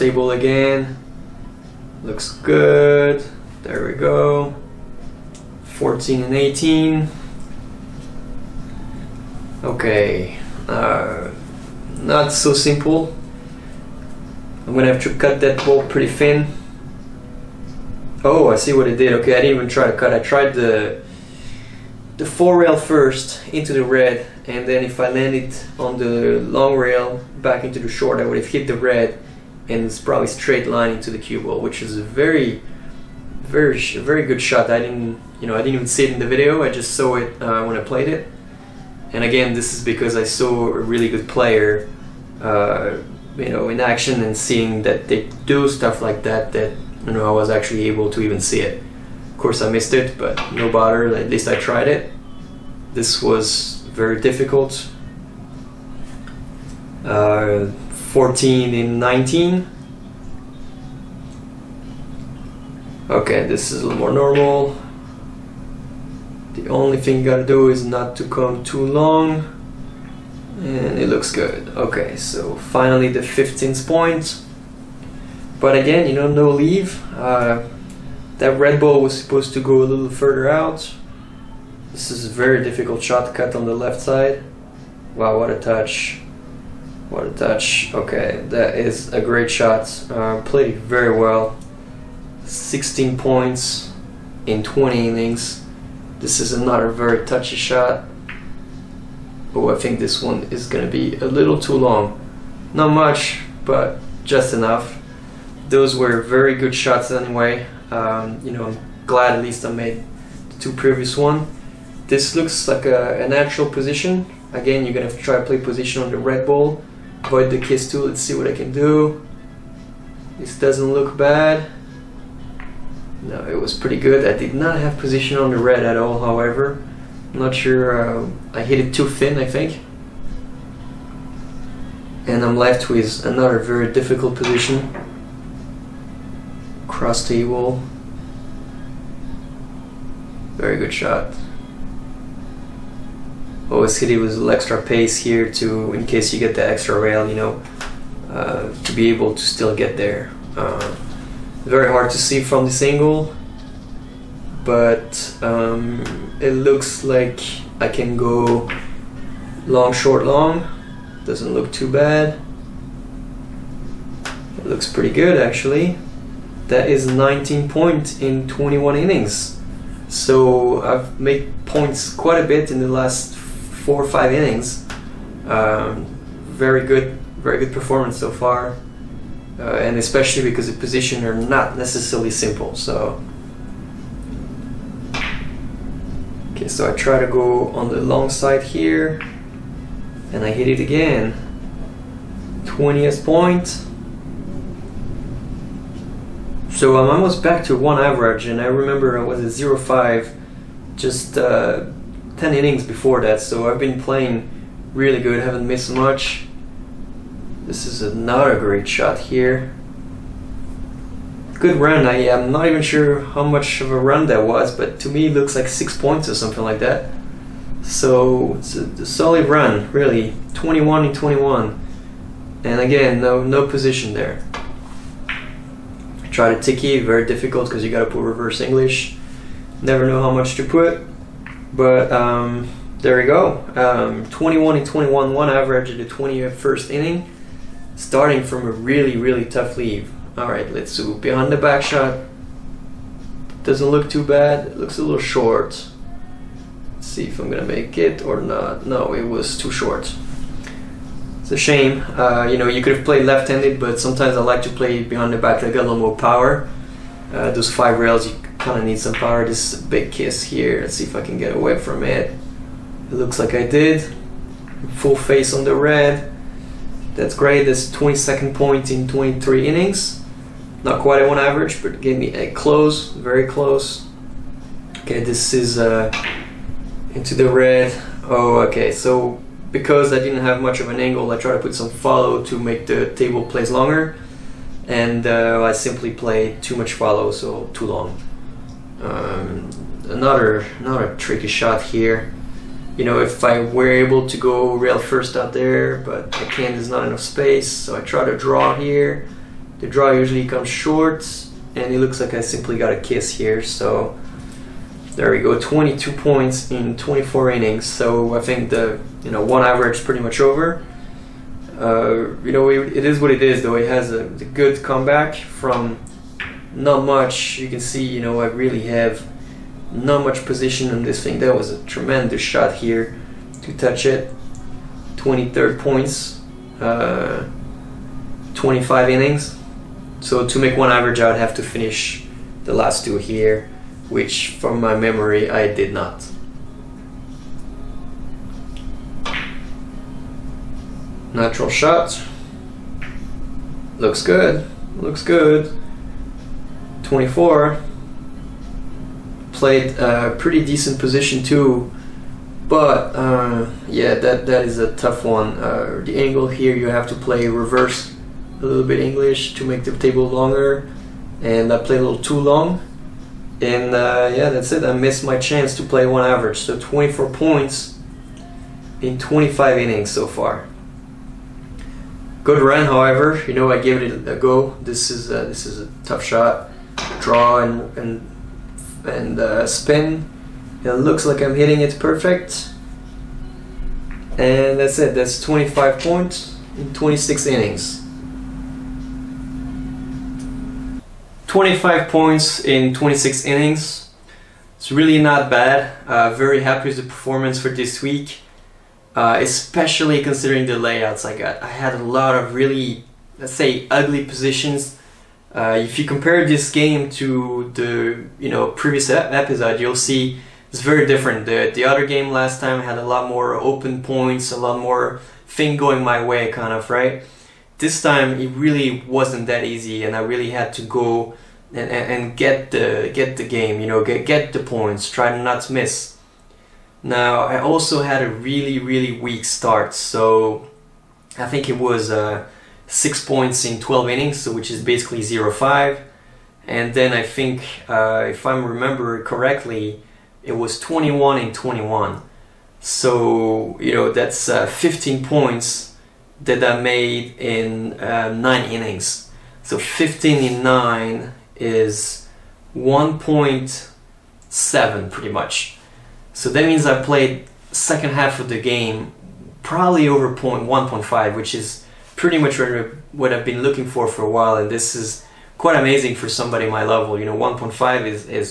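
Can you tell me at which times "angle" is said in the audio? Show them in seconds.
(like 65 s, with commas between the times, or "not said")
152 s, 281 s, 356 s.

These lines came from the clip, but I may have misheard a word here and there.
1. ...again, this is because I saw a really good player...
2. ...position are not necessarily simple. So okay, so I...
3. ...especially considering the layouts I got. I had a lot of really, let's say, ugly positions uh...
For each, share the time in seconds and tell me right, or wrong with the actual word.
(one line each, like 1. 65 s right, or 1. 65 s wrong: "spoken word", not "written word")
1. 39 s right
2. 180 s right
3. 399 s right.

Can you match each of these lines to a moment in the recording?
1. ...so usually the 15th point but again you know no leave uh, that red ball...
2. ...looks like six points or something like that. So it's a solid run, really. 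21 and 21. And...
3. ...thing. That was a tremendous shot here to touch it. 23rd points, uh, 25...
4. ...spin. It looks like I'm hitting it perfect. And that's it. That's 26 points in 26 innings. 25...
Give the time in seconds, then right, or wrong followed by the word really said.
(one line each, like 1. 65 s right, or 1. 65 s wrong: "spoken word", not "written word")
1. 72 s wrong: "finally", not "usually"
2. 215 s right
3. 321 s right
4. 379 s wrong: "25", not "26".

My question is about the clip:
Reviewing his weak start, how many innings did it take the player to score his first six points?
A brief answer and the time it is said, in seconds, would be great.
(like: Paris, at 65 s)
12, at 433 s.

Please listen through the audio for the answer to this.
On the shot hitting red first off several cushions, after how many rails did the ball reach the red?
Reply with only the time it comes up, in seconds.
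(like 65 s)
22 s.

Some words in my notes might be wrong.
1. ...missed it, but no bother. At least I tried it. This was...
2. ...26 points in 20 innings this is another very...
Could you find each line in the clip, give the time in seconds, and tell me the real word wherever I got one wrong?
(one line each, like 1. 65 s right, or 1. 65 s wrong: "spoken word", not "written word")
1. 49 s right
2. 92 s wrong: "16", not "26".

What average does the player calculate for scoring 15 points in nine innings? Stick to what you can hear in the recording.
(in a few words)
1.7.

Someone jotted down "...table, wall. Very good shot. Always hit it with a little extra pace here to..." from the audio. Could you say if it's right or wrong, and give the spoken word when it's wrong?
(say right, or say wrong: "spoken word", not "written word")
right.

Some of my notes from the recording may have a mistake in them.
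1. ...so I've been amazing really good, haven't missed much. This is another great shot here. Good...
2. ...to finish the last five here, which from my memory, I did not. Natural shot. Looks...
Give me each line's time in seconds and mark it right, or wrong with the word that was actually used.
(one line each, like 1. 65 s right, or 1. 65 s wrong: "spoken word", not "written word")
1. 203 s wrong: "playing", not "amazing"
2. 331 s wrong: "two", not "five".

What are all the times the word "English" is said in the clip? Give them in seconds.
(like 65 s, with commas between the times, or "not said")
228 s, 358 s.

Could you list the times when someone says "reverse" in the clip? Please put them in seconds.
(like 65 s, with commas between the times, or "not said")
228 s, 357 s.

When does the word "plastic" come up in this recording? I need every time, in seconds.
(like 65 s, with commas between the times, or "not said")
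not said.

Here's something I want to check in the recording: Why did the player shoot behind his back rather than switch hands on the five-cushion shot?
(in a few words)
more power.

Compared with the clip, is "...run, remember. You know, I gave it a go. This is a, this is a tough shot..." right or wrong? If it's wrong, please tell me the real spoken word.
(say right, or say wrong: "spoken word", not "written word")
wrong: "however", not "remember".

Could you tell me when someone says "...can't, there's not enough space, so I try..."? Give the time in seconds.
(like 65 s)
296 s.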